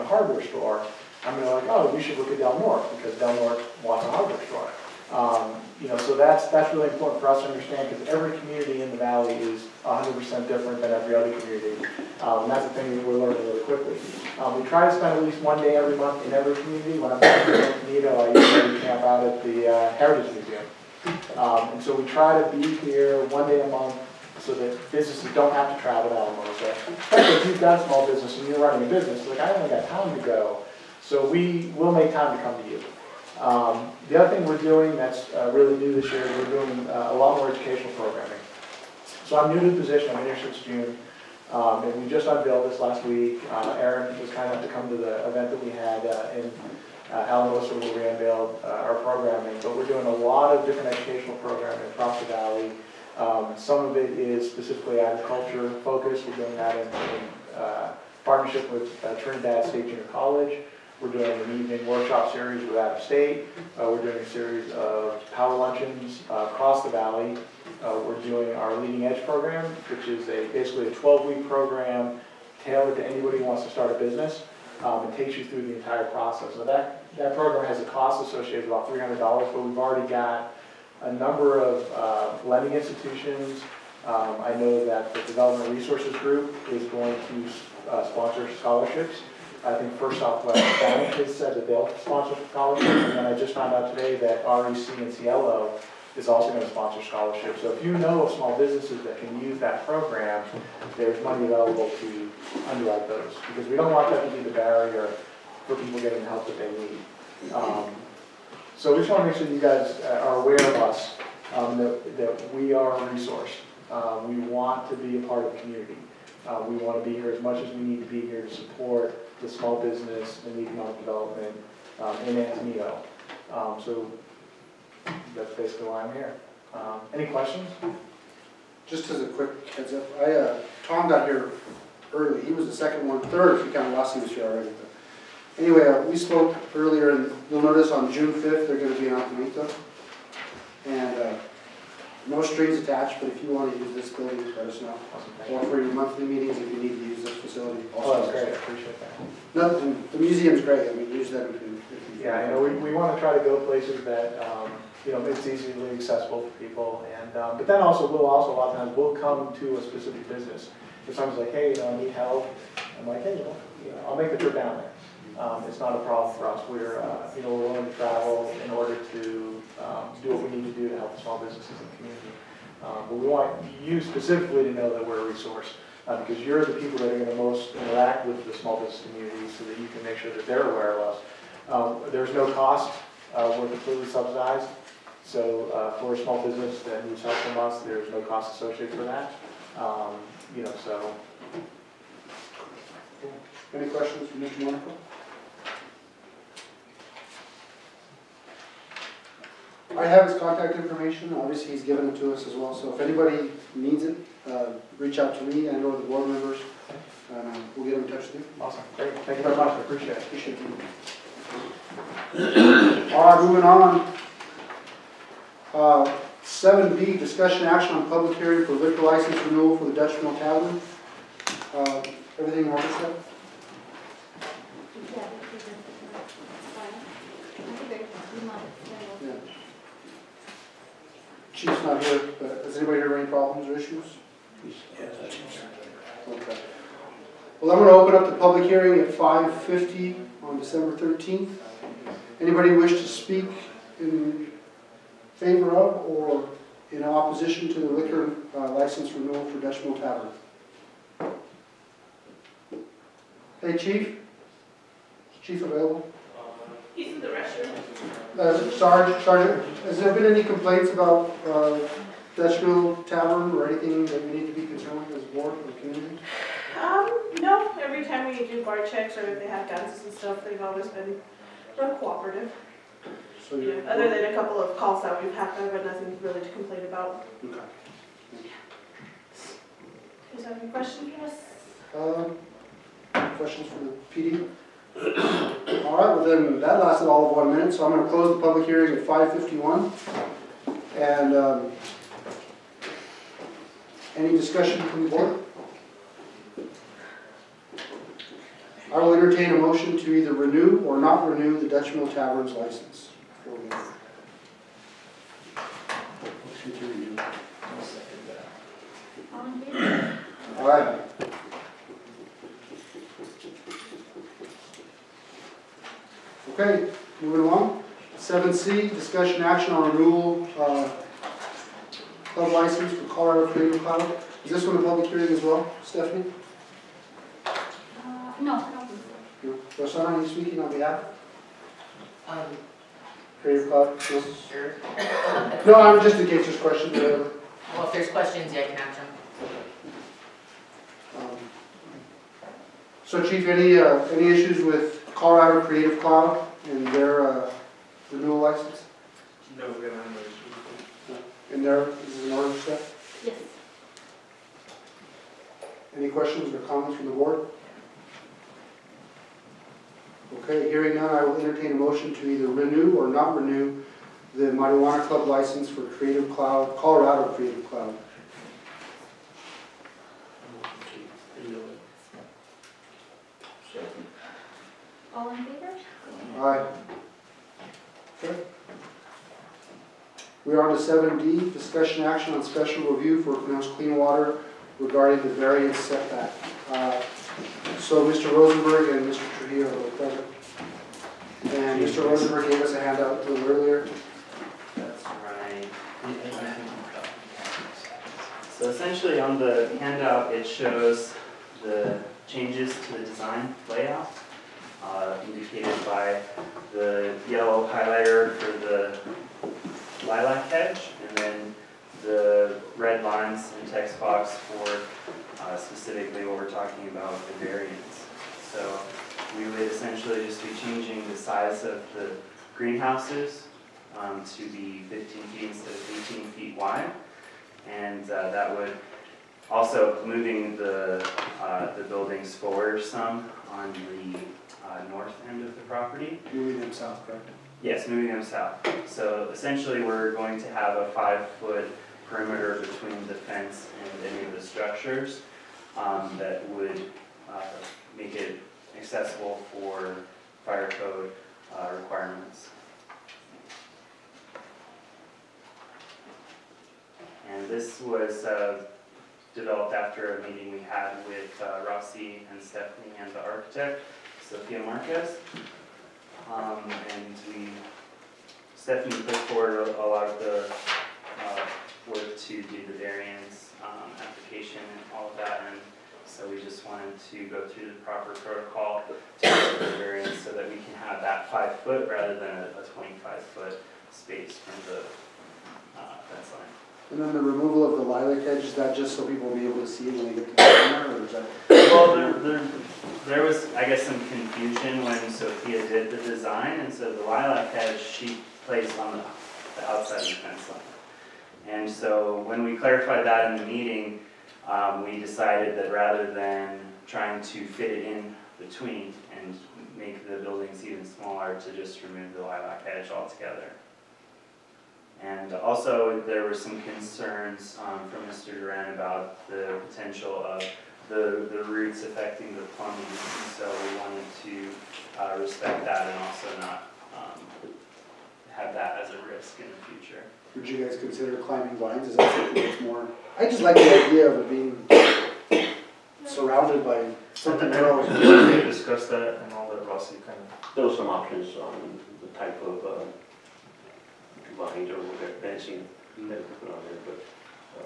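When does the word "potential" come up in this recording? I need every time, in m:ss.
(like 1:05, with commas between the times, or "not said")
8:39.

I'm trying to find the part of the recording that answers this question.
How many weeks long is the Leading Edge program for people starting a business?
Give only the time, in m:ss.
1:10.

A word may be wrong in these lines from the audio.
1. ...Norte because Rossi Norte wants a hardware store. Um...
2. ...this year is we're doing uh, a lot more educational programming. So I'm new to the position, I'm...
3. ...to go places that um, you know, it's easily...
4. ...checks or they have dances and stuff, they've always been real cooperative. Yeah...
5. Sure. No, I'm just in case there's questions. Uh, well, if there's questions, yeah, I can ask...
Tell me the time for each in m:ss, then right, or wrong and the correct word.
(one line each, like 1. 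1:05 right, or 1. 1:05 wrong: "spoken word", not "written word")
1. 0:02 wrong: "Del", not "Rossi"
2. 0:36 right
3. 2:33 right
4. 4:28 right
5. 5:34 right.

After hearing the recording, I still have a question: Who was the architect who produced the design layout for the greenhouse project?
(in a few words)
Sophia Marquez.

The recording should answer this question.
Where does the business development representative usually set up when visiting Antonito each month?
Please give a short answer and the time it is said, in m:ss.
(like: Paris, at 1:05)
Heritage Museum, at 0:19.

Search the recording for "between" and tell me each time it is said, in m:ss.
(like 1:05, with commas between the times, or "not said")
7:22, 8:28.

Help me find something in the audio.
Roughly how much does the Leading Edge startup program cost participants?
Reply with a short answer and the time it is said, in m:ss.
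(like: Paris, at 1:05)
$300, at 1:18.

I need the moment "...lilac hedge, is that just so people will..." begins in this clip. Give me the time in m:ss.
8:07.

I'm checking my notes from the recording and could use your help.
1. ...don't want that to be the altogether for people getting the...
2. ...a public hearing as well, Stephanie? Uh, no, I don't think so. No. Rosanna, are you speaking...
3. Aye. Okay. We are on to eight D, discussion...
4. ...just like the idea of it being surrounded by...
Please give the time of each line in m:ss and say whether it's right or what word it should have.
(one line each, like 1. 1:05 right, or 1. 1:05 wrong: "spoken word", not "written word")
1. 1:43 wrong: "barrier", not "altogether"
2. 5:24 right
3. 6:16 wrong: "seven", not "eight"
4. 8:53 right.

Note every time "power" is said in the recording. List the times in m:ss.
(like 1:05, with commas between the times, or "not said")
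1:05.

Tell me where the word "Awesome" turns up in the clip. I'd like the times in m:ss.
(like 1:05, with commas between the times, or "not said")
2:25, 3:28.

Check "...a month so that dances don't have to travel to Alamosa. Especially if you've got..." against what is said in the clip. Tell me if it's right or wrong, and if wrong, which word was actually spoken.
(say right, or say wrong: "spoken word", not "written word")
wrong: "businesses", not "dances".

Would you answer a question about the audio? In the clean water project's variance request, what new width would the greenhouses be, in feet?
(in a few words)
15 feet.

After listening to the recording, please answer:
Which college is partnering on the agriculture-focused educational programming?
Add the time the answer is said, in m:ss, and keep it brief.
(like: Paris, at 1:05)
Trinidad State Junior College, at 0:59.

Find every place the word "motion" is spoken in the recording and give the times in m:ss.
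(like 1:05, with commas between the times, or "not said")
4:59, 6:01.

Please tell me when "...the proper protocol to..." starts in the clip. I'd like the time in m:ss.
7:57.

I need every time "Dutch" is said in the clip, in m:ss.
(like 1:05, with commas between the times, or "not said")
3:39, 4:09, 5:01.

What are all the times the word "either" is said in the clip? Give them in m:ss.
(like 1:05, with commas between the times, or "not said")
5:00, 6:02.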